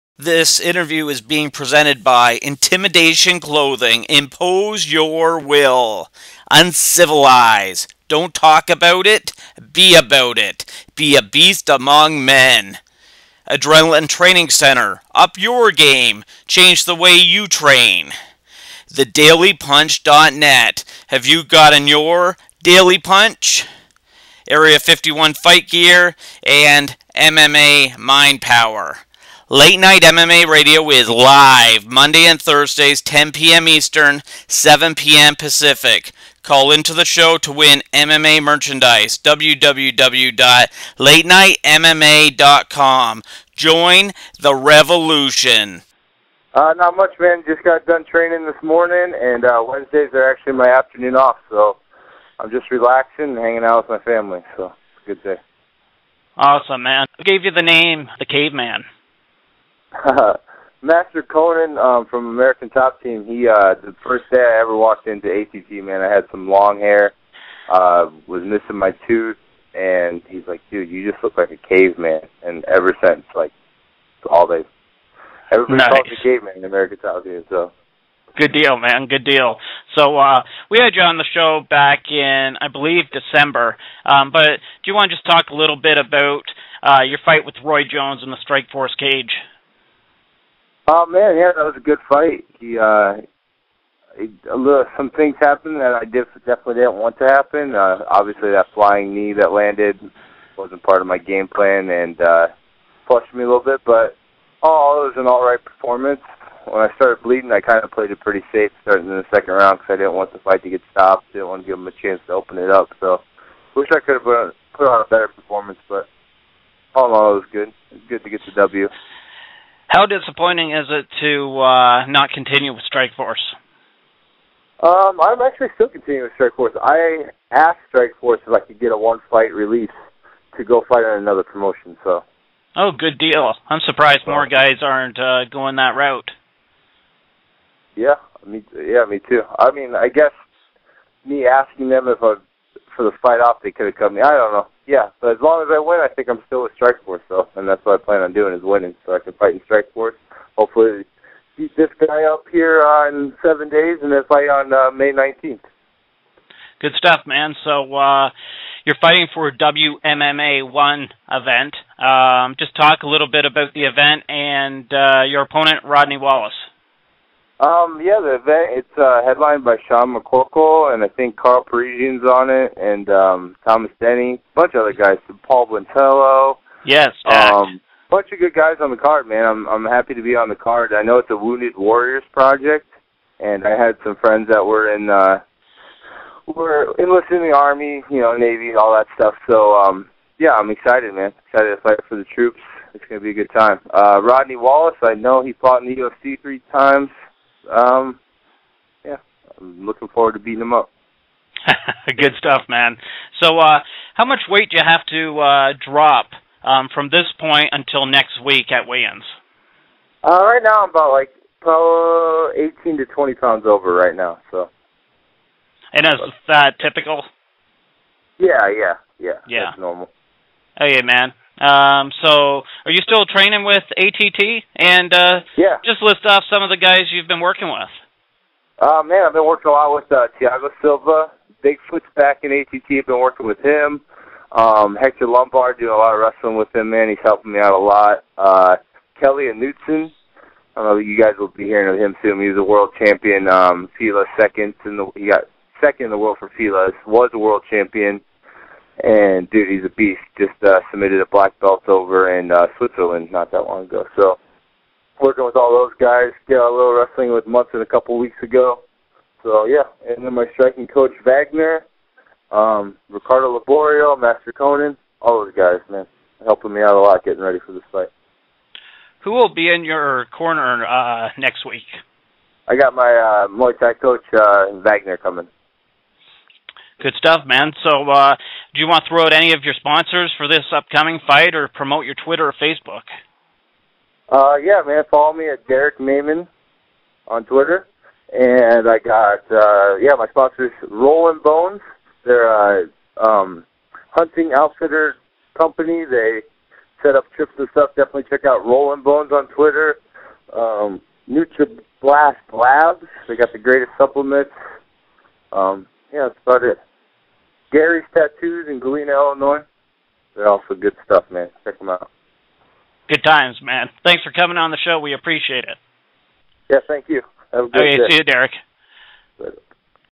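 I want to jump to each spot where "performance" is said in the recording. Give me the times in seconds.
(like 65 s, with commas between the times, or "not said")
105 s, 115 s.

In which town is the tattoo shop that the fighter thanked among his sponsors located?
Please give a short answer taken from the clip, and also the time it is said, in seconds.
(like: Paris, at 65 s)
Galena, Illinois, at 308 s.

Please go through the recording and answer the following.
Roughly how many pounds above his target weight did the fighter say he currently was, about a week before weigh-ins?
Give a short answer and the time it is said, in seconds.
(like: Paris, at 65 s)
18 to 20, at 212 s.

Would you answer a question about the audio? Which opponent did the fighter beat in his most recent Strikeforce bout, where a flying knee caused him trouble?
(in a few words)
Roy Jones.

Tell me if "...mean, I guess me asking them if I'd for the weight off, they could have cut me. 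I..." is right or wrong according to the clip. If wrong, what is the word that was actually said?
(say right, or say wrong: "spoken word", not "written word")
wrong: "fight", not "weight".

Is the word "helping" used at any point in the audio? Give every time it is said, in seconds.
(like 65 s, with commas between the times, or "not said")
237 s, 266 s.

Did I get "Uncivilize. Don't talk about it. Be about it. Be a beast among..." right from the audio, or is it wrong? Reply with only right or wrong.
right.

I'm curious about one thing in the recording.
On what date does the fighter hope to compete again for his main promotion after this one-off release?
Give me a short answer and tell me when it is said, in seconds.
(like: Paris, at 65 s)
May 19, at 154 s.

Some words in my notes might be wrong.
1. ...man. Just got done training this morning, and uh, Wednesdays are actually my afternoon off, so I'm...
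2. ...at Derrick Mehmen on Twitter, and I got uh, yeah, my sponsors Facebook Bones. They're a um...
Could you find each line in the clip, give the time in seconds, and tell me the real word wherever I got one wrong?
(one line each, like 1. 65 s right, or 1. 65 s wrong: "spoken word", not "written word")
1. 47 s right
2. 285 s wrong: "Rolling", not "Facebook".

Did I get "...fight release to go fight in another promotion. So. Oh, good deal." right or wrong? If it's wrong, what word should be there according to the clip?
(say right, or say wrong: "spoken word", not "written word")
right.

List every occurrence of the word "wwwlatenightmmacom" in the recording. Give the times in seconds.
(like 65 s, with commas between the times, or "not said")
39 s.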